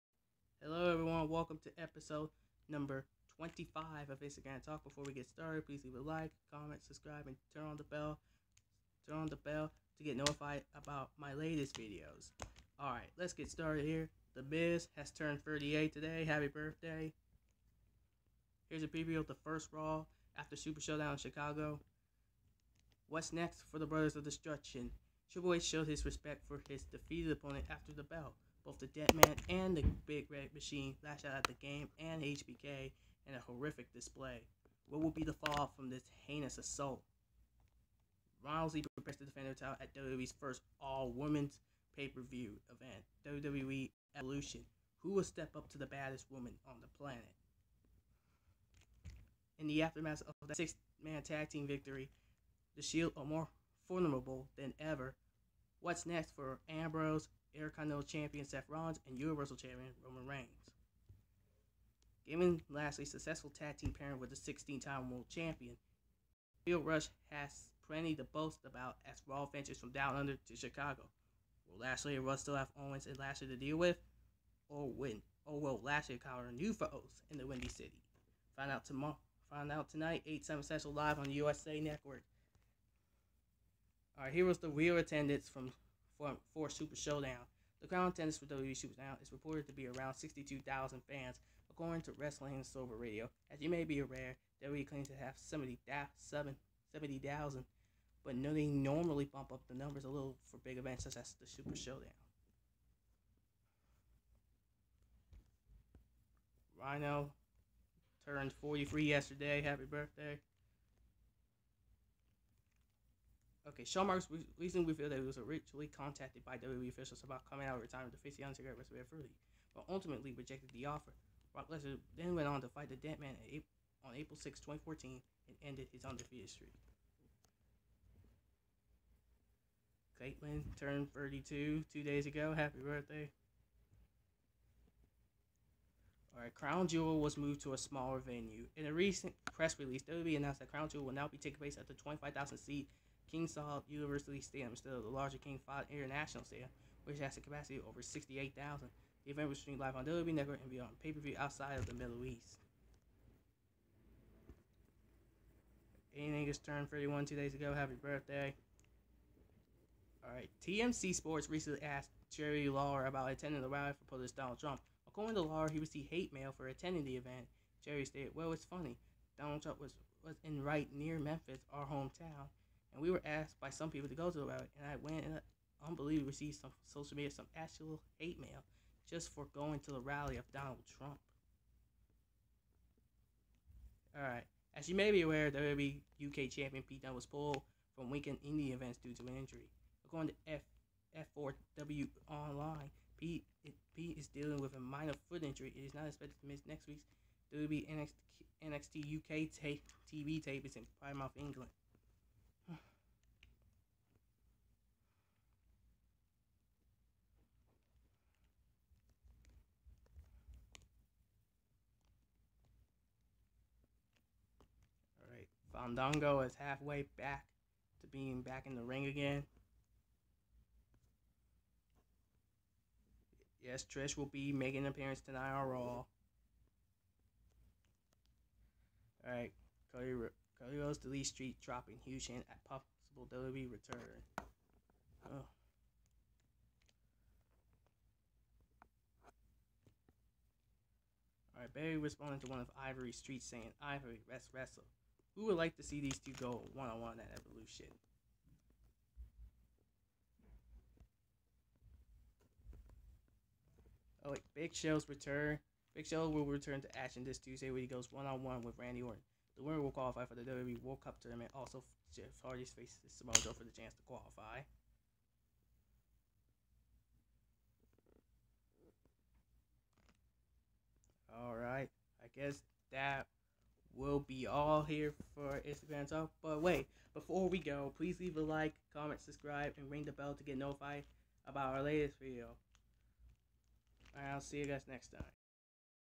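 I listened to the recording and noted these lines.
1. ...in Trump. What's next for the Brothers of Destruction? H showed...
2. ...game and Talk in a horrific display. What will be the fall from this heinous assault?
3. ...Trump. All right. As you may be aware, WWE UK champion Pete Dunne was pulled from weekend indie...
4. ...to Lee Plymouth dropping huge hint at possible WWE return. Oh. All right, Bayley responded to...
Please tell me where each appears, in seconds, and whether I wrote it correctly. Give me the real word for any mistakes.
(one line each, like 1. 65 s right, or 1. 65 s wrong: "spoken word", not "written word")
1. 21 s wrong: "Chicago", not "Trump"
2. 31 s wrong: "HBK", not "Talk"
3. 180 s right
4. 230 s wrong: "Street", not "Plymouth".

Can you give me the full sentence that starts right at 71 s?
Will Lashley and Russ still have Owens and Lashley to deal with, or win?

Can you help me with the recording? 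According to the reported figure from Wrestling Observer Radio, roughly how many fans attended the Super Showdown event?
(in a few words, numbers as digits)
62,000.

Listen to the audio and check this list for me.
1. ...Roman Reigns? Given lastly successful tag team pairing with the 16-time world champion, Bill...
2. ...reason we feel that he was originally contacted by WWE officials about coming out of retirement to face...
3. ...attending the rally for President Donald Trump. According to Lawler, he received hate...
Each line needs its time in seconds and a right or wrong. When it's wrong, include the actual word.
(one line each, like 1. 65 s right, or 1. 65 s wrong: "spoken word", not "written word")
1. 60 s right
2. 114 s right
3. 163 s right.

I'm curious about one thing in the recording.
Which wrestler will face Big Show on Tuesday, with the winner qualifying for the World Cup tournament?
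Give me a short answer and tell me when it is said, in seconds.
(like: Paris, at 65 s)
Randy Orton, at 258 s.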